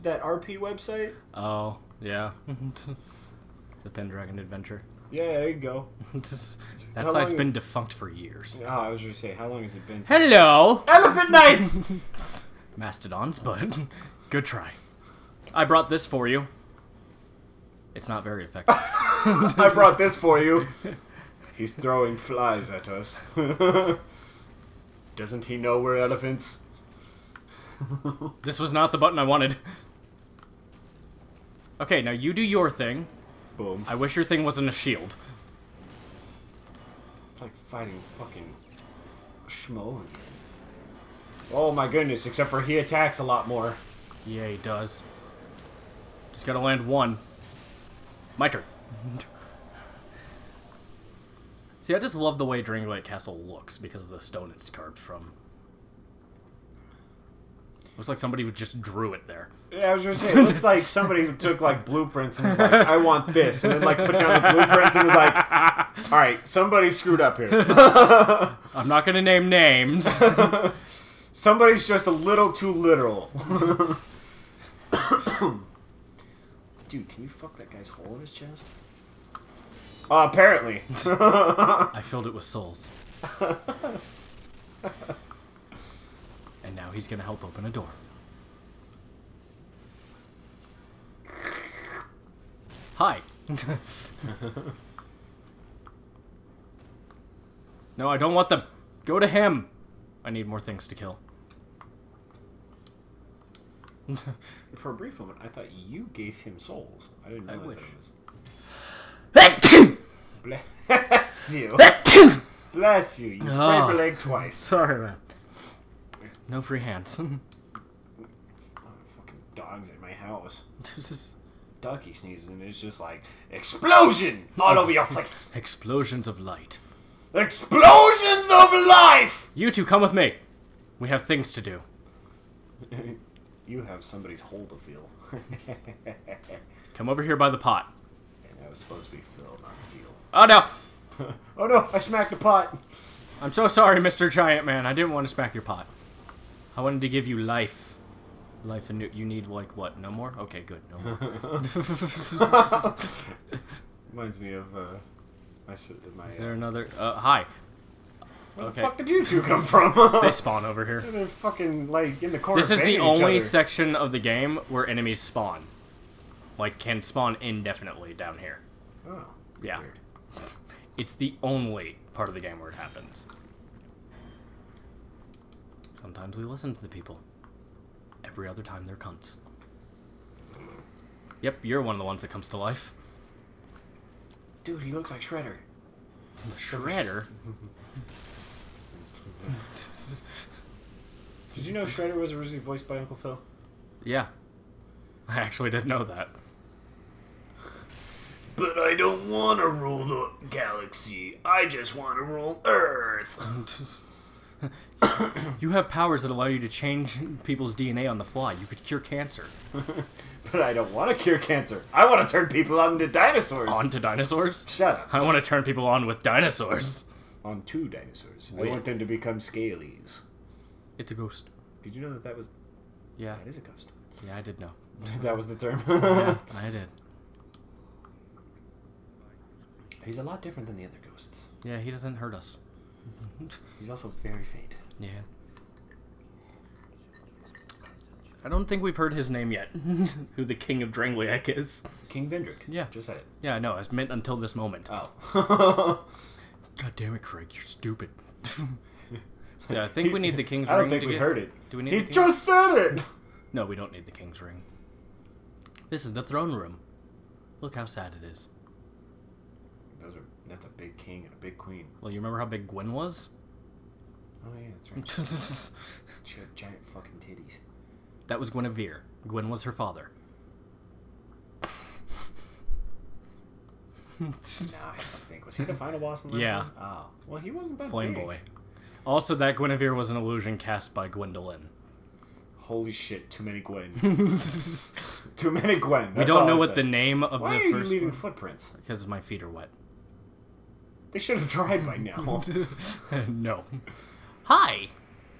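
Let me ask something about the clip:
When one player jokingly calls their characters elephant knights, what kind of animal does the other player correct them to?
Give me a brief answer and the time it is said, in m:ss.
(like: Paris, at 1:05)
Mastodons, at 0:12.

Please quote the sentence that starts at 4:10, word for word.
I don't ring think we get...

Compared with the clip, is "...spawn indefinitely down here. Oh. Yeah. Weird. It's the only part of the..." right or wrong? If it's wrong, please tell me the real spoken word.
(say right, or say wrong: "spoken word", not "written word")
right.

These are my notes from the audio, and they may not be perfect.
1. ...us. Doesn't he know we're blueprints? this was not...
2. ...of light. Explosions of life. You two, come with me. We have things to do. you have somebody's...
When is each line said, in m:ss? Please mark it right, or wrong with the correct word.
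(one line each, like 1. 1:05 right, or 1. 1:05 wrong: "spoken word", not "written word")
1. 0:22 wrong: "elephants", not "blueprints"
2. 2:06 right.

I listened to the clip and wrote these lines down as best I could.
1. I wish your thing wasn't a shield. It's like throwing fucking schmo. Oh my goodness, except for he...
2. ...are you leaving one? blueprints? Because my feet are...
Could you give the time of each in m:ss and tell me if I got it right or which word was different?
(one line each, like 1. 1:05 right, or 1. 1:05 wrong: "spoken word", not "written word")
1. 0:33 wrong: "fighting", not "throwing"
2. 4:47 wrong: "footprints", not "blueprints".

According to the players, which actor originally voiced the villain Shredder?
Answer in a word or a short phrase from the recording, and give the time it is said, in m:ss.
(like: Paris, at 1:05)
Uncle Phil, at 3:12.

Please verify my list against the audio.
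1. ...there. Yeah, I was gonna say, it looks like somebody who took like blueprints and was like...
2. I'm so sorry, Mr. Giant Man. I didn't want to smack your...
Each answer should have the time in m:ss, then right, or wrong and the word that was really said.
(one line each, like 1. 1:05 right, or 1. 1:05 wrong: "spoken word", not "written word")
1. 0:59 right
2. 2:23 right.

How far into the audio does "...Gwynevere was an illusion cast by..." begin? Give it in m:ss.
4:39.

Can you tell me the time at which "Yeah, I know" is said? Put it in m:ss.
4:03.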